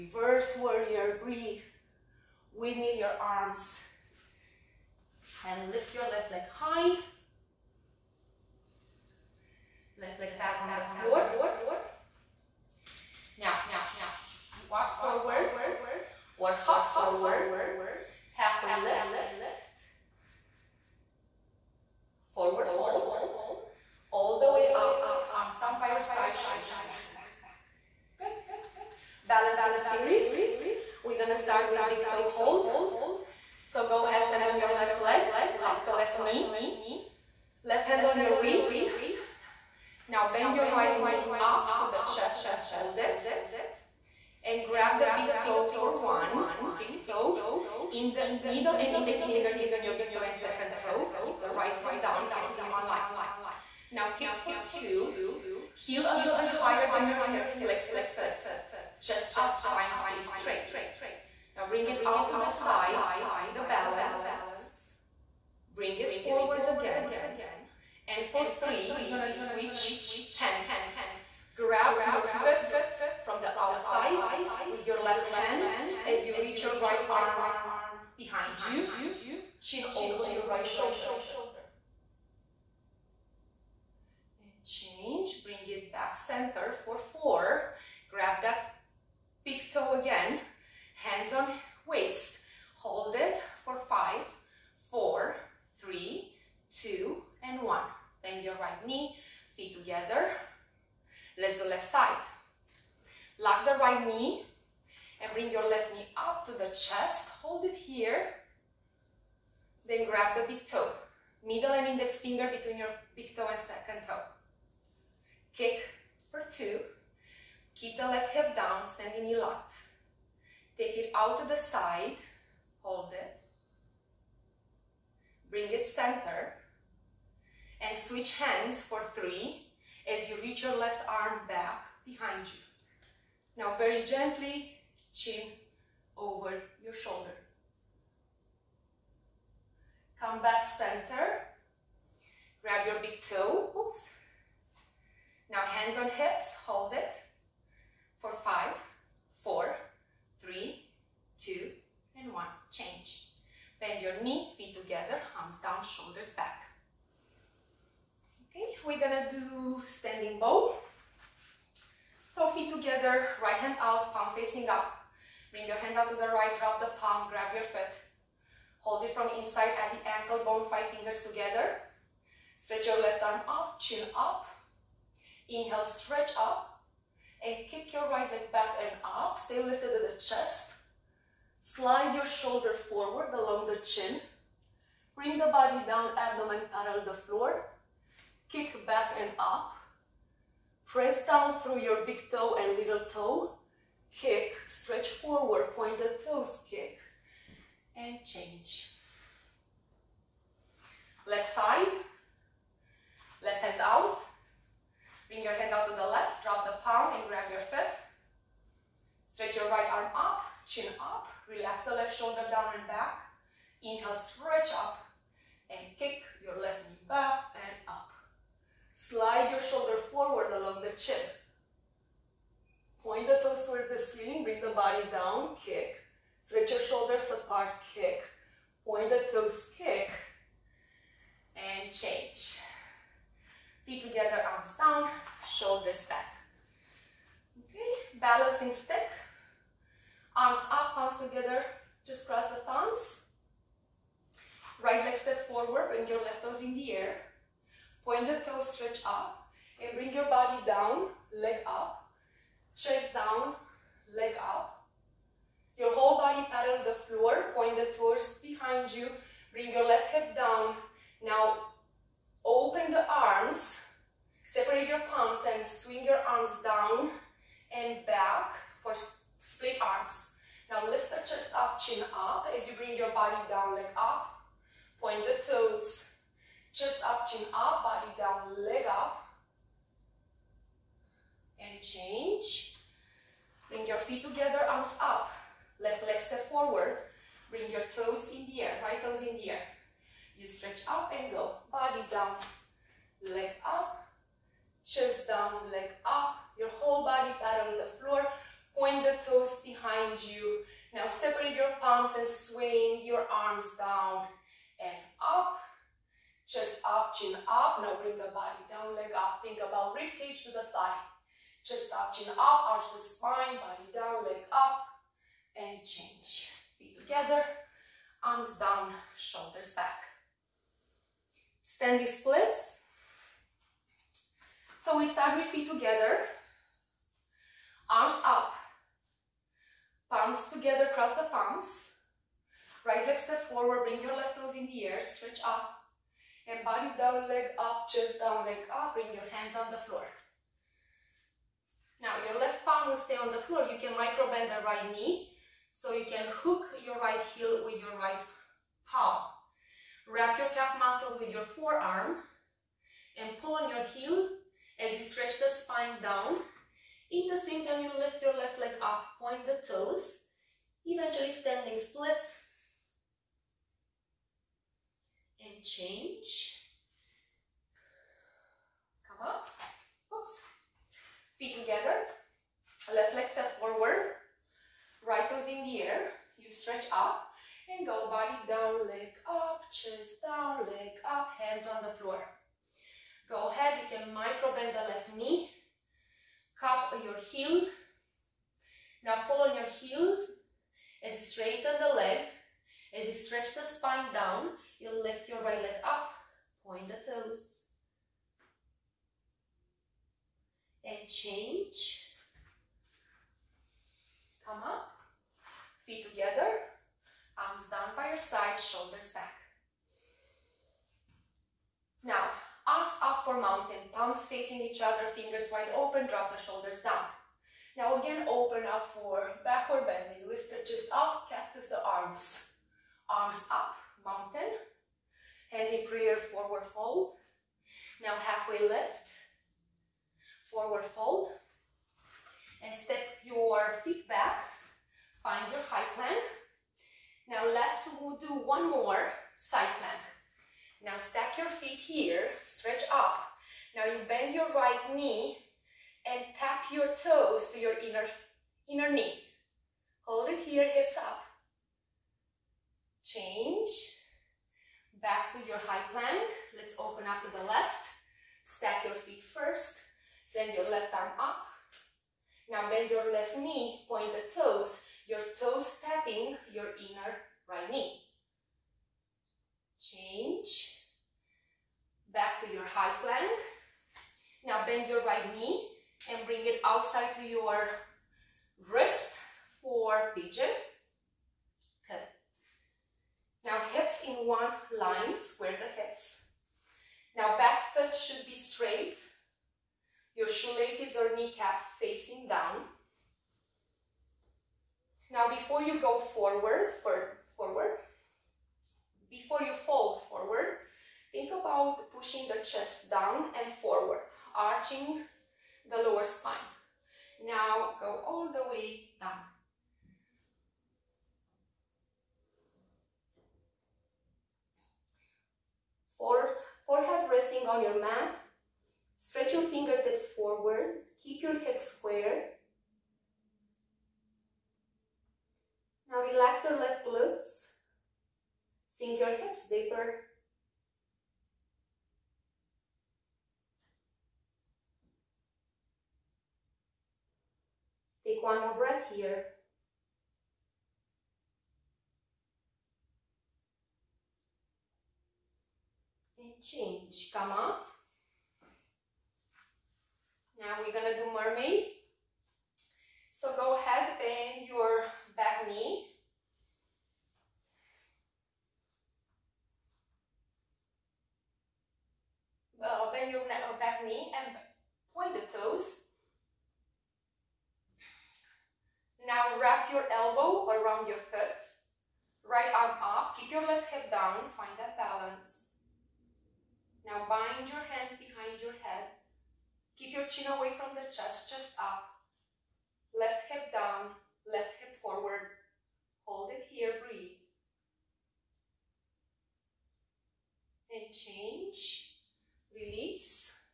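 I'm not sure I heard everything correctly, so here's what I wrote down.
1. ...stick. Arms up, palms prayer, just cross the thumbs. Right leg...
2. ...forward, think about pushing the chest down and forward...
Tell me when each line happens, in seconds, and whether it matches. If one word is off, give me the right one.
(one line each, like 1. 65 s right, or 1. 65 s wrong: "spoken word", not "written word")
1. 238 s wrong: "together", not "prayer"
2. 500 s right.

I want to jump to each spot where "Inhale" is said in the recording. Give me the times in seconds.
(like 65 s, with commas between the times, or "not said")
175 s, 213 s.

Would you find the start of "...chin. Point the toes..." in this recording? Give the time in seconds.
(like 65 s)
220 s.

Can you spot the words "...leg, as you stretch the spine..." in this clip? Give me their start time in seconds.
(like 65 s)
391 s.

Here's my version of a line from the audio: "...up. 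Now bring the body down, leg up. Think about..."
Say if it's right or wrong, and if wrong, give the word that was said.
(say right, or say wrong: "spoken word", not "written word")
right.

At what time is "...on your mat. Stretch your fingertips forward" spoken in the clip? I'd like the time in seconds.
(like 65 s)
517 s.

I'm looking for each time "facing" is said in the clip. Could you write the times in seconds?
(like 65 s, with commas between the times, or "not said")
164 s, 414 s, 491 s.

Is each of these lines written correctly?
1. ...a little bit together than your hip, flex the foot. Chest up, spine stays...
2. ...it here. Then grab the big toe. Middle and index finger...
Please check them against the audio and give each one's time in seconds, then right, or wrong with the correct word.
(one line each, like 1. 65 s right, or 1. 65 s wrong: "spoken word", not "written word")
1. 56 s wrong: "higher", not "together"
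2. 107 s right.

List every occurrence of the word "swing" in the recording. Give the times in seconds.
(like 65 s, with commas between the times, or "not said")
265 s, 302 s.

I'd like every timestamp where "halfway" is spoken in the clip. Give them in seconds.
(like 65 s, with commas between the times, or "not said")
18 s, 428 s.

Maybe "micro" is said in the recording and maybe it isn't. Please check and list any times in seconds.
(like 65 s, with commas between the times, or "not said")
343 s, 384 s.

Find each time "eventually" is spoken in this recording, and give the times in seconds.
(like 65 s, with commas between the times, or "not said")
360 s.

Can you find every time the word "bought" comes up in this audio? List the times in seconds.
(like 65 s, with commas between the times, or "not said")
not said.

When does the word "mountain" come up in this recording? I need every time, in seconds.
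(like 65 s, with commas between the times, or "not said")
413 s, 424 s.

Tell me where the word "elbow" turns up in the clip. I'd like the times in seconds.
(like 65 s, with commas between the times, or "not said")
569 s.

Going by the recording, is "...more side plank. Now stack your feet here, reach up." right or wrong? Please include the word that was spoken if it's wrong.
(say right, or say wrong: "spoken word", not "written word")
wrong: "stretch", not "reach".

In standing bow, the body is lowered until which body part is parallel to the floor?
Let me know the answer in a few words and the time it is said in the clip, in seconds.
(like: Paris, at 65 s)
Abdomen, at 186 s.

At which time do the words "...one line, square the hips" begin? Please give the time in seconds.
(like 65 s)
484 s.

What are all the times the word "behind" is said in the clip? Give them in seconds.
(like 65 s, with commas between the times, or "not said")
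78 s, 132 s, 258 s, 299 s, 577 s.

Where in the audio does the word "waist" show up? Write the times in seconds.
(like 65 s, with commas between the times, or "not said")
38 s.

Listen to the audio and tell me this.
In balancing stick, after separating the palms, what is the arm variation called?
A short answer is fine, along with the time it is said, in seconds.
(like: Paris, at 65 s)
Split arms, at 269 s.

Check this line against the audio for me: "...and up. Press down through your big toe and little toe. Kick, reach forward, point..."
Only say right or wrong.
wrong.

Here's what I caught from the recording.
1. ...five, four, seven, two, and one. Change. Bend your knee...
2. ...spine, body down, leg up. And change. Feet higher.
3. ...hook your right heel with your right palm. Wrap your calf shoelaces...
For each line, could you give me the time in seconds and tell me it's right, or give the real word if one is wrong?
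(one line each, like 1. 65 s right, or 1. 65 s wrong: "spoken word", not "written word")
1. 148 s wrong: "three", not "seven"
2. 312 s wrong: "together", not "higher"
3. 346 s wrong: "muscles", not "shoelaces".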